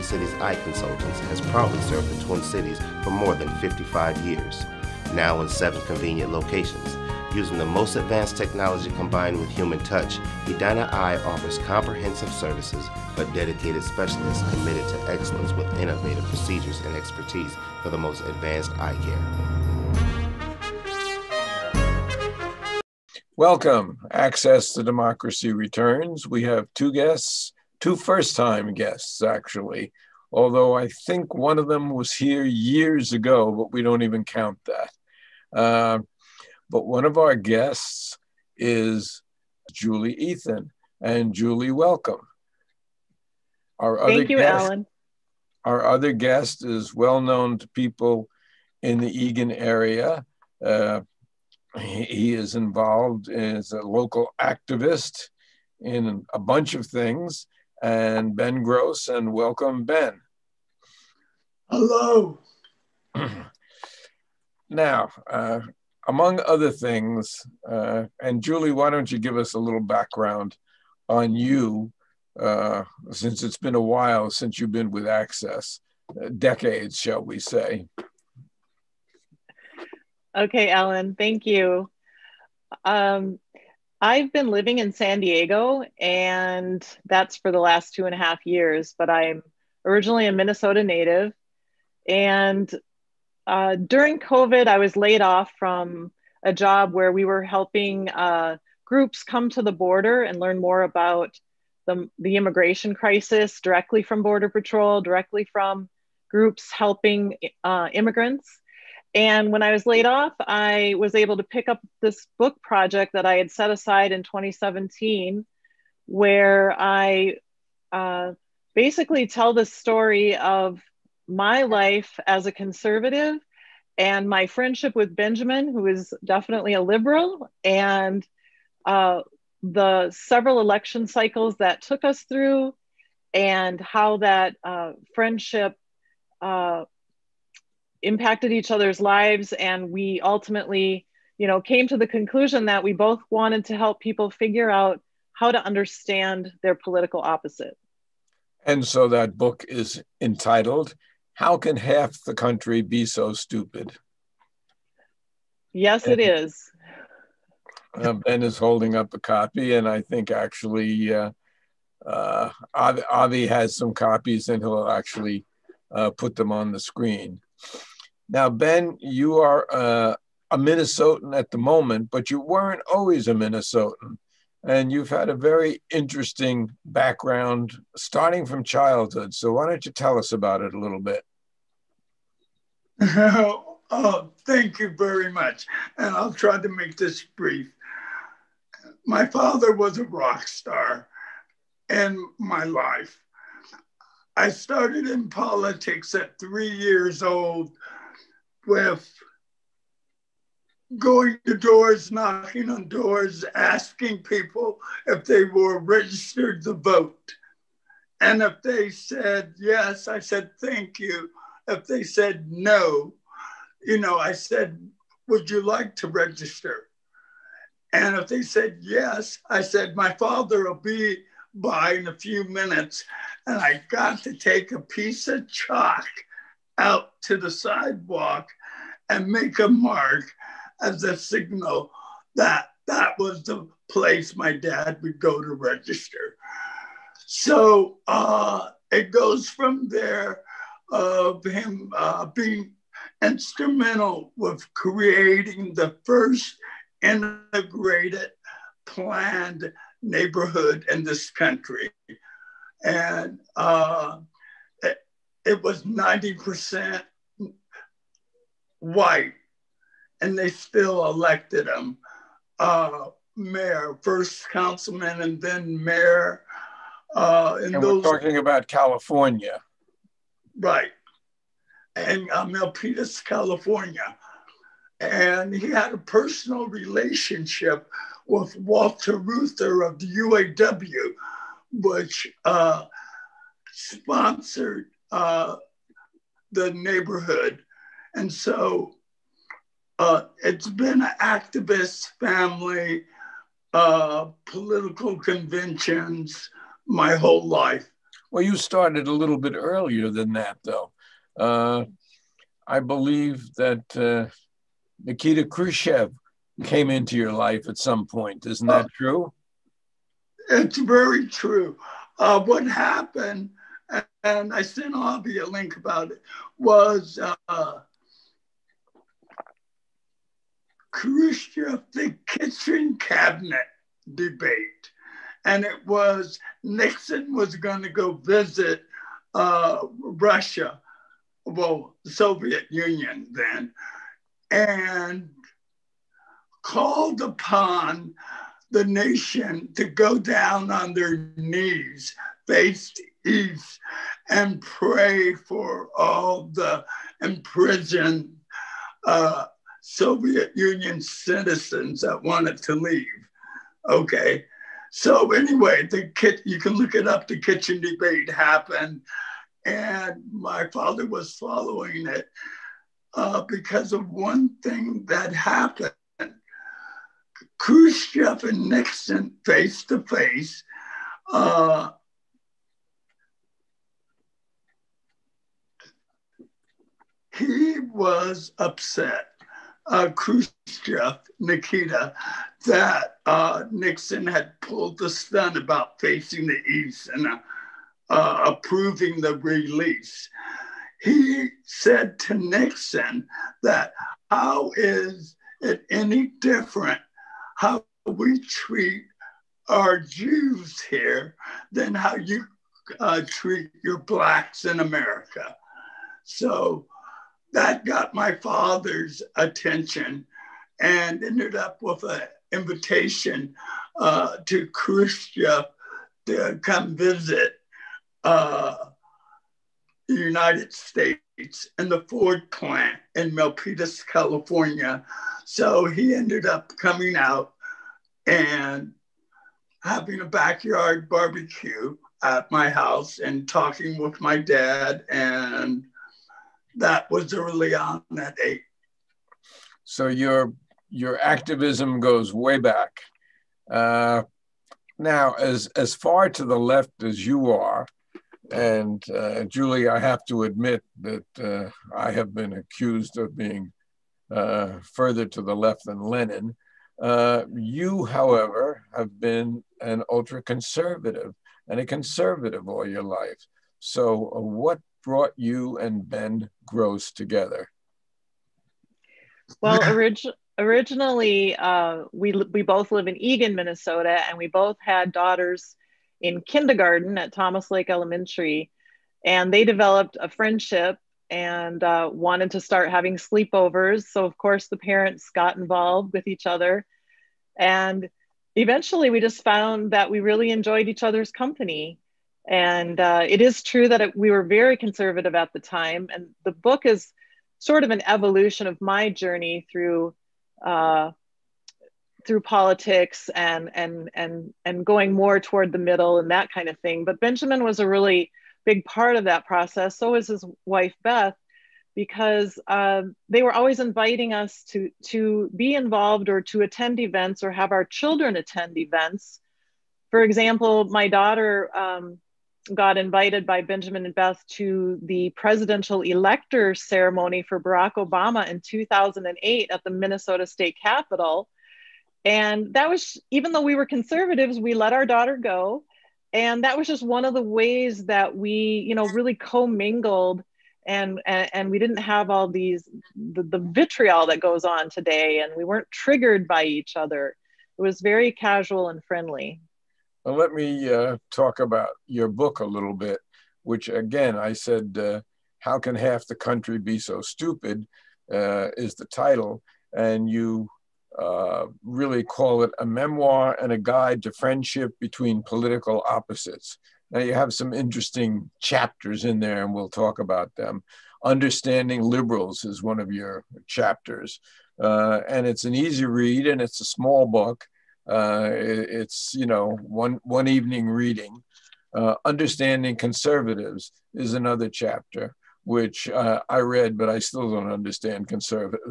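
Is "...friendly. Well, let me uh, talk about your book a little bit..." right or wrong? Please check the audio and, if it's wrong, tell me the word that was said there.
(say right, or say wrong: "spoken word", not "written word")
right.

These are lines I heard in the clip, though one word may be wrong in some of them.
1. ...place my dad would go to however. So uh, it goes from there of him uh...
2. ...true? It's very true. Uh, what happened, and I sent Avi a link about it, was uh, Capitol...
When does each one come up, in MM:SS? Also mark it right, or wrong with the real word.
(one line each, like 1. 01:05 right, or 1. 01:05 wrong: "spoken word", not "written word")
1. 03:53 wrong: "register", not "however"
2. 05:08 wrong: "Khrushchev", not "Capitol".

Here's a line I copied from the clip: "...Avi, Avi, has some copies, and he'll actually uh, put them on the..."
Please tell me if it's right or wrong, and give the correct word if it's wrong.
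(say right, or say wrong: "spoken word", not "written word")
right.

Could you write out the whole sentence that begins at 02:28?
And so that book is entitled how can half the country be so stupid?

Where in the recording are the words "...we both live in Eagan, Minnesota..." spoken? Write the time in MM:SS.
07:52.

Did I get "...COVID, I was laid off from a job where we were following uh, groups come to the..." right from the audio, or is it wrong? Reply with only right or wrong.
wrong.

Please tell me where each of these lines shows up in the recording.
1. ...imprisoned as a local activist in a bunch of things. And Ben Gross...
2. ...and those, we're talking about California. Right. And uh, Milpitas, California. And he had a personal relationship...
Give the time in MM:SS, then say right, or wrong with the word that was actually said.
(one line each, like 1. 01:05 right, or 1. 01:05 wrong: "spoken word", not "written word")
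1. 00:52 wrong: "involved", not "imprisoned"
2. 04:27 right.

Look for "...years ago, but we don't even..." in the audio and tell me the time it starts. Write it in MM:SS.
00:32.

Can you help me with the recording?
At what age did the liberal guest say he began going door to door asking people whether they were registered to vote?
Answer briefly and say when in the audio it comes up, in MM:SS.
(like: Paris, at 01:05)
Three, at 03:16.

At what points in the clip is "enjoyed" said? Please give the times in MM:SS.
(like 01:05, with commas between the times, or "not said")
08:10.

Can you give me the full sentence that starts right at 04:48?
And so uh, it's been an activist family, uh, political conventions my whole life.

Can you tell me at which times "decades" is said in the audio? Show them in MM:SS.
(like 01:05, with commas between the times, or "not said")
01:16.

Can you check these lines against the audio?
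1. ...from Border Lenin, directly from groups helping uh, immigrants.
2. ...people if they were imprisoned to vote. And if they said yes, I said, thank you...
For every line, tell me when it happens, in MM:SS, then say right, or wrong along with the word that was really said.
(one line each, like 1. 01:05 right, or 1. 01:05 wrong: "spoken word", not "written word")
1. 01:44 wrong: "Patrol", not "Lenin"
2. 03:24 wrong: "registered", not "imprisoned".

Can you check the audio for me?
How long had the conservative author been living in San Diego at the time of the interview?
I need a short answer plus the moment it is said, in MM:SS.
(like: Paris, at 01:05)
Two and a half years, at 01:27.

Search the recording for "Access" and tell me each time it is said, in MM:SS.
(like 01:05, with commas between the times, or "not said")
00:24, 01:15.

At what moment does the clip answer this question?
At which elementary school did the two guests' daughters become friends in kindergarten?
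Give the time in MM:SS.
07:57.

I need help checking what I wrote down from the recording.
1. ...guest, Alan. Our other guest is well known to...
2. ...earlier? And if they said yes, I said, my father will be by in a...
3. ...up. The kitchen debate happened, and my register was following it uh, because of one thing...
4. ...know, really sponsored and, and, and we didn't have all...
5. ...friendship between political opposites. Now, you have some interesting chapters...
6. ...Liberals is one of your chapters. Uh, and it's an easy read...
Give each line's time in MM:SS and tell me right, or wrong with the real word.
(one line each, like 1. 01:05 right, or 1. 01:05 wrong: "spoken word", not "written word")
1. 00:44 right
2. 03:36 wrong: "register", not "earlier"
3. 05:57 wrong: "father", not "register"
4. 08:58 wrong: "commingled", not "sponsored"
5. 09:24 right
6. 09:32 right.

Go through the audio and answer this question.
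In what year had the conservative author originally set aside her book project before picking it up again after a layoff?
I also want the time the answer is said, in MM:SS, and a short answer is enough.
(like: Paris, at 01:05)
2017, at 01:54.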